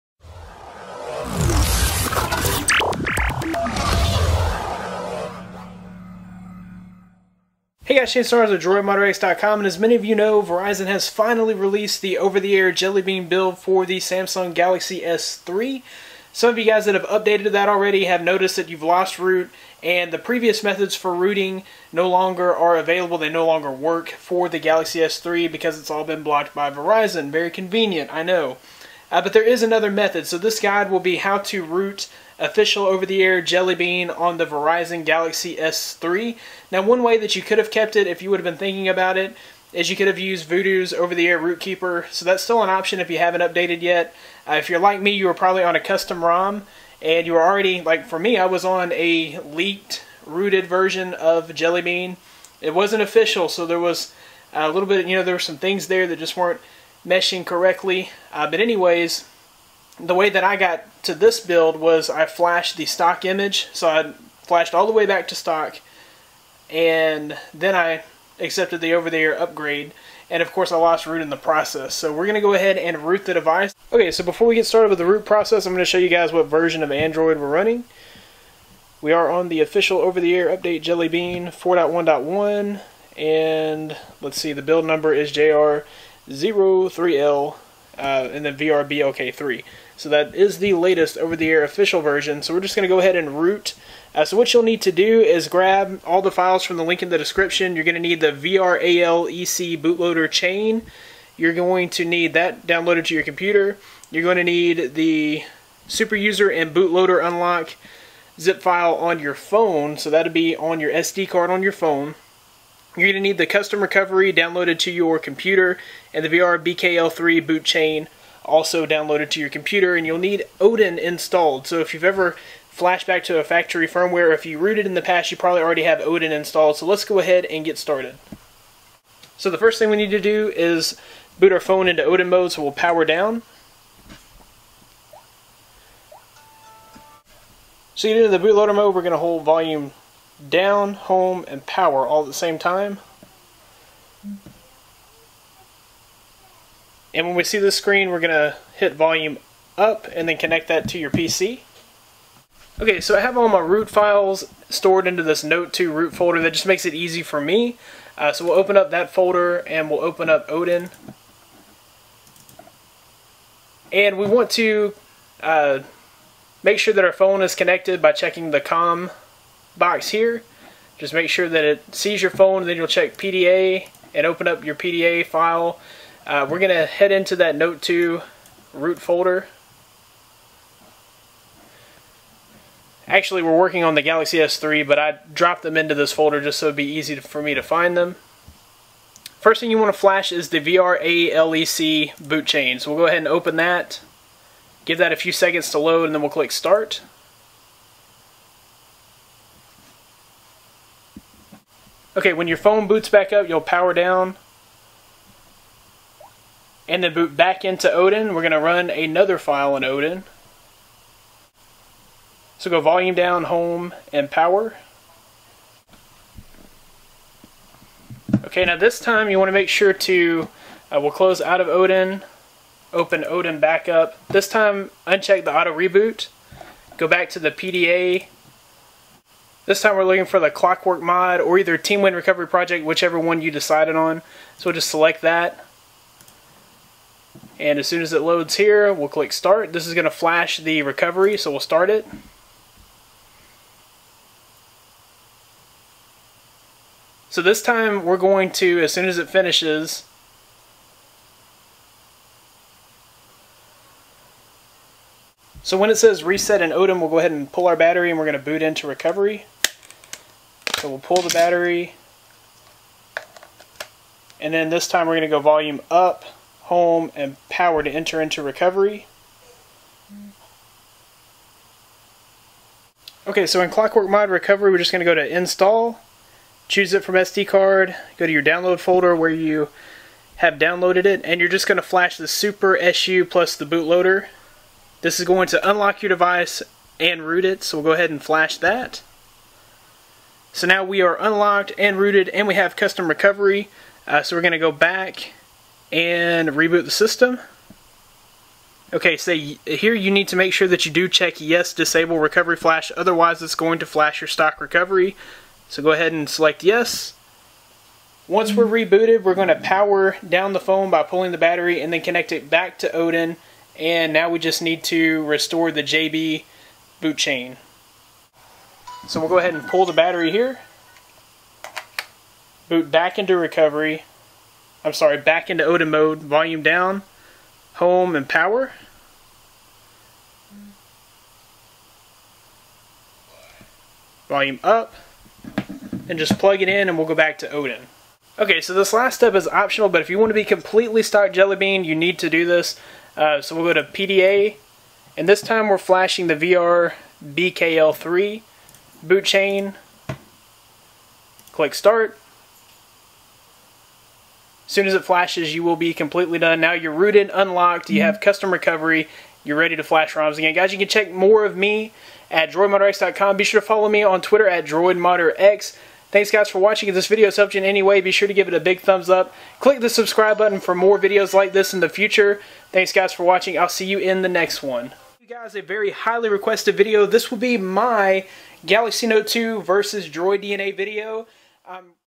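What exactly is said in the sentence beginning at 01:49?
So that'll be on your SD card on your phone.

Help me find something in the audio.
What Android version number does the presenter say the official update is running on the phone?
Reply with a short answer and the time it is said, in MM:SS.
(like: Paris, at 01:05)
4.1.1, at 01:21.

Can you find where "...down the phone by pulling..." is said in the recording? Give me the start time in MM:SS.
05:10.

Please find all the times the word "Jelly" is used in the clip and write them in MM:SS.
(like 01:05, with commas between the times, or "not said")
00:12, 00:33, 00:51, 01:20, 05:41.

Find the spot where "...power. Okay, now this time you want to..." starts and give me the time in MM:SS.
03:34.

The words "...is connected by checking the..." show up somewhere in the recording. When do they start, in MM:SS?
02:47.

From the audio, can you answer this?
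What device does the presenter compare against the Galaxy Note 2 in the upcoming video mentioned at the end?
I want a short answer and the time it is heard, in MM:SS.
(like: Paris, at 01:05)
Droid DNA, at 06:20.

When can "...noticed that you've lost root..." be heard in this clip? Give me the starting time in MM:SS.
00:18.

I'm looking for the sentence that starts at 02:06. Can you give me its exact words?
So let's go ahead and get started.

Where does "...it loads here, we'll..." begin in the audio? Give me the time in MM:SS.
03:58.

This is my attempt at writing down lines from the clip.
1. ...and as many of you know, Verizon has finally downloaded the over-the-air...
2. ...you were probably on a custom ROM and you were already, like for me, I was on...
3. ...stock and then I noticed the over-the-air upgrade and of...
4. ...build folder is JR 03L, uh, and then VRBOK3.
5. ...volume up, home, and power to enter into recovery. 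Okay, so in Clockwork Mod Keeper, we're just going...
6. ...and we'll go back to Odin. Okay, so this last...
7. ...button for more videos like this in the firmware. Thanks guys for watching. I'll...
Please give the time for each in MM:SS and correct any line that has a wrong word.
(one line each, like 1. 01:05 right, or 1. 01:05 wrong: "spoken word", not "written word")
1. 00:09 wrong: "released", not "downloaded"
2. 00:45 right
3. 01:05 wrong: "accepted", not "noticed"
4. 01:24 wrong: "number", not "folder"
5. 04:25 wrong: "Recovery", not "Keeper"
6. 05:36 right
7. 06:10 wrong: "future", not "firmware".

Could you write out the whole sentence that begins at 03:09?
First thing you want to flash is the VRALEC boot chain.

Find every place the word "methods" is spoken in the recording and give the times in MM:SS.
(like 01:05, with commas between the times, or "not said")
00:20, 00:29.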